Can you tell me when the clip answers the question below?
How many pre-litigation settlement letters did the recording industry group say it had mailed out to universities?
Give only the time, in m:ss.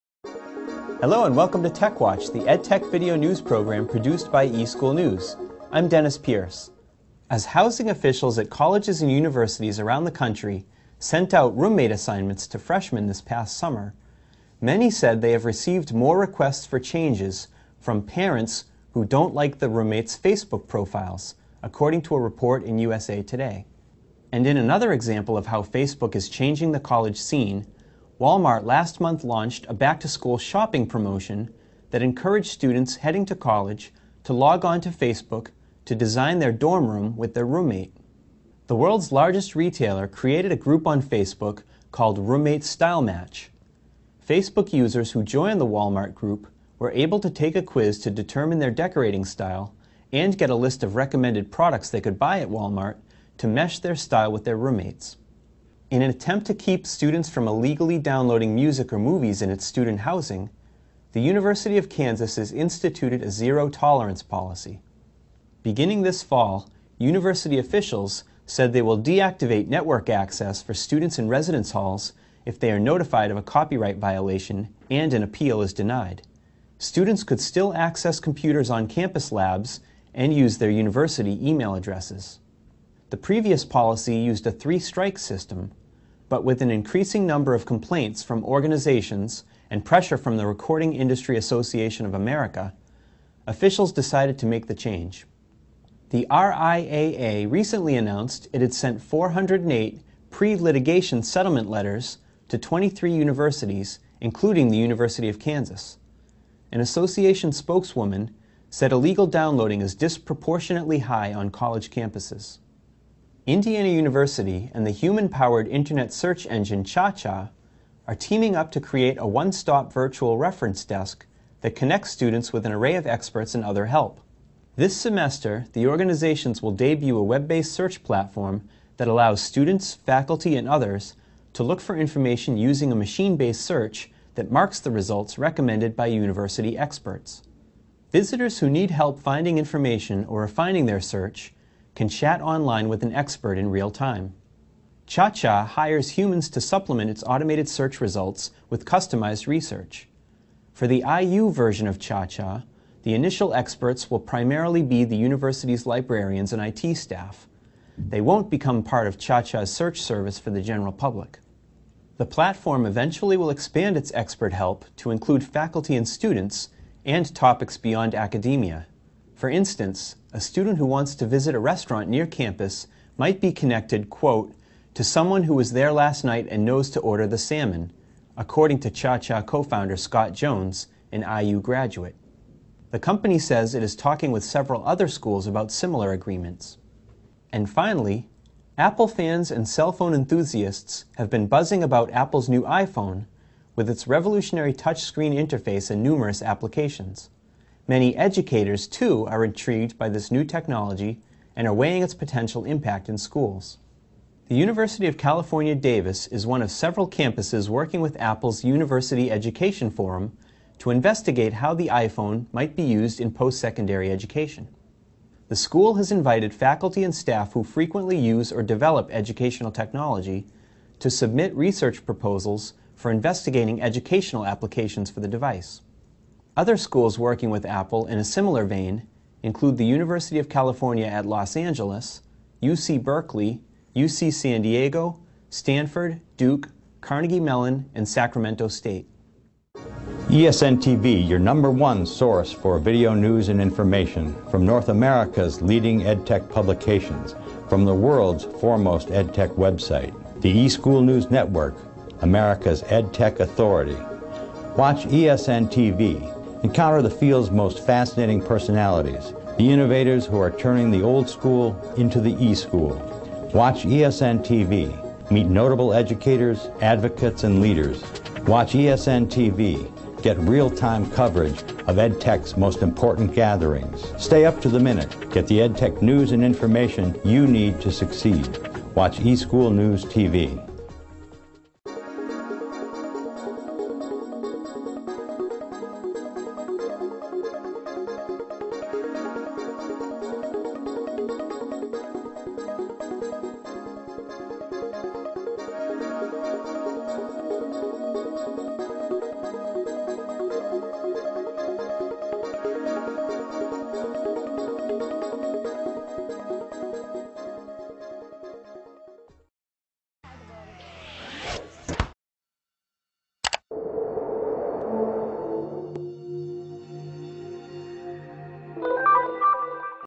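1:39.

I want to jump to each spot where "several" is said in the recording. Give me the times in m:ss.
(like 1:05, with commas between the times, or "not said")
3:04, 3:26.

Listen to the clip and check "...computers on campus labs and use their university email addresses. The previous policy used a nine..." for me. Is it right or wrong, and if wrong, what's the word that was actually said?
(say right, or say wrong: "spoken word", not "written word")
wrong: "three", not "nine".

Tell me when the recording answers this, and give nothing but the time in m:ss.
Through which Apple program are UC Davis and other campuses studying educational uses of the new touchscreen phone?
3:28.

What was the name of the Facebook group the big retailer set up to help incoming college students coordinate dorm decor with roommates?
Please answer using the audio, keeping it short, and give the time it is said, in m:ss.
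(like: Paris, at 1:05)
Roommate Style Match, at 0:42.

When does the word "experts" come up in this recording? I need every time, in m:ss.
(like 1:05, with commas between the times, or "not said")
2:03, 2:16, 2:23, 2:33, 2:44.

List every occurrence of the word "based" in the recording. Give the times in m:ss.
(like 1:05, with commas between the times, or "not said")
2:07, 2:12.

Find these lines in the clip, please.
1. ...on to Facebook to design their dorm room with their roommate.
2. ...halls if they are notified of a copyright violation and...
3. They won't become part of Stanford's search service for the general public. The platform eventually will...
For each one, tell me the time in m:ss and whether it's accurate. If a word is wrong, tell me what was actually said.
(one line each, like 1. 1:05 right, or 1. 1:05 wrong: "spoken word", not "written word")
1. 0:34 right
2. 1:11 right
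3. 2:37 wrong: "ChaCha", not "Stanford".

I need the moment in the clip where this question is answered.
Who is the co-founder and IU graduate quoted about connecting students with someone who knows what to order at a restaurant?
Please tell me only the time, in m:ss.
2:59.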